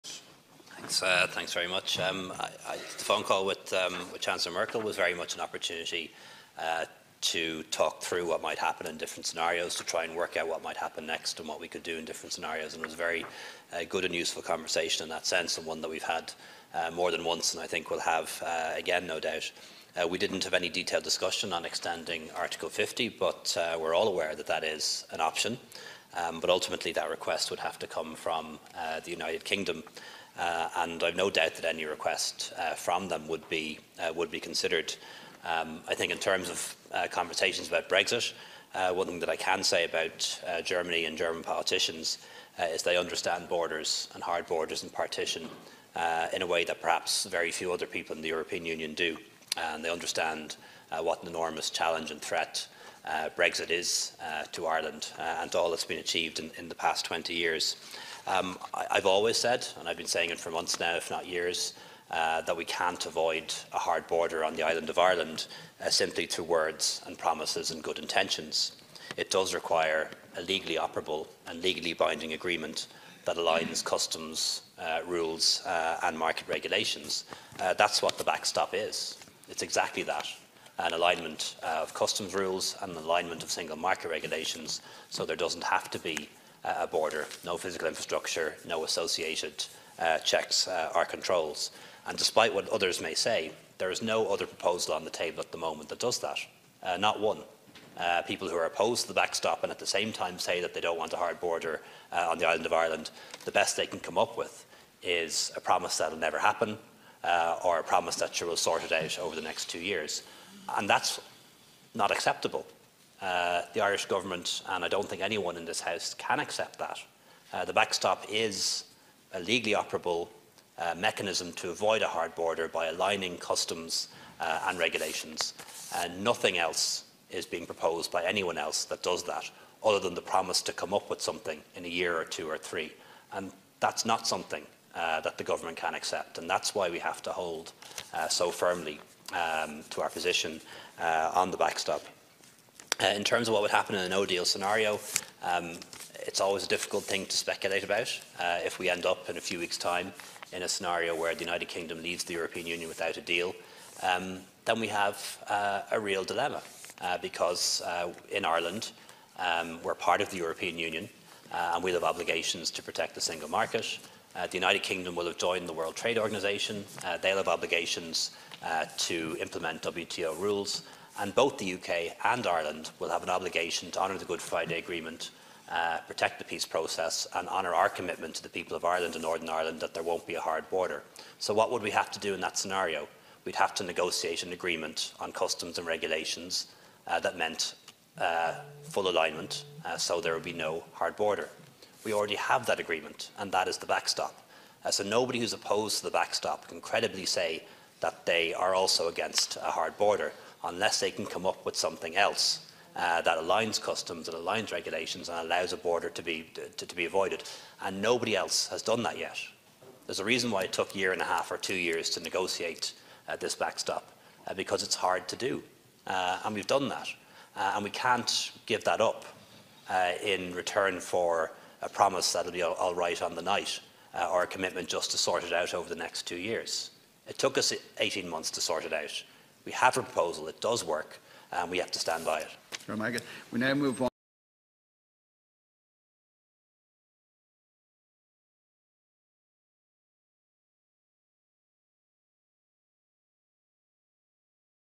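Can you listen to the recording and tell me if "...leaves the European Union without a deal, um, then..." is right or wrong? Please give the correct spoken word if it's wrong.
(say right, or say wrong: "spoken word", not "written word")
right.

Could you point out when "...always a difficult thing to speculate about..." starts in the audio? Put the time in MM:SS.
02:26.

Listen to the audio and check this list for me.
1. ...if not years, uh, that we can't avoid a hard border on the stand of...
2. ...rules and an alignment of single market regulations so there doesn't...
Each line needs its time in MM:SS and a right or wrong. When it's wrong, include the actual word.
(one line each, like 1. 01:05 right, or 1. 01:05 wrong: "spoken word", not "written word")
1. 01:00 wrong: "island", not "stand"
2. 01:22 right.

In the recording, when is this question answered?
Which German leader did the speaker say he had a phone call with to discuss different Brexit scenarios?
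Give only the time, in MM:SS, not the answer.
00:04.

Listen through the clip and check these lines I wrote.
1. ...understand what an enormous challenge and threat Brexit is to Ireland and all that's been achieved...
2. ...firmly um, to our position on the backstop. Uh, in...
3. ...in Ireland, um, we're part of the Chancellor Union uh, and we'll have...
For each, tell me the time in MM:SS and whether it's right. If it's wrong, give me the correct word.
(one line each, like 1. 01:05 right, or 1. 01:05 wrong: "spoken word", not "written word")
1. 00:49 right
2. 02:18 right
3. 02:38 wrong: "European", not "Chancellor".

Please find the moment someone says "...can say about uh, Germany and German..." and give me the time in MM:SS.
00:39.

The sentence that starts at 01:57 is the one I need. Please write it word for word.
Uh, the backstop is a legally operable uh, mechanism to avoid a hard border by aligning customs uh, and regulations.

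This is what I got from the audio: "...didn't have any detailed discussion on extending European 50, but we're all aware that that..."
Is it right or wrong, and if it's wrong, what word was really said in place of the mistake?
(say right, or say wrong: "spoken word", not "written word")
wrong: "Article", not "European".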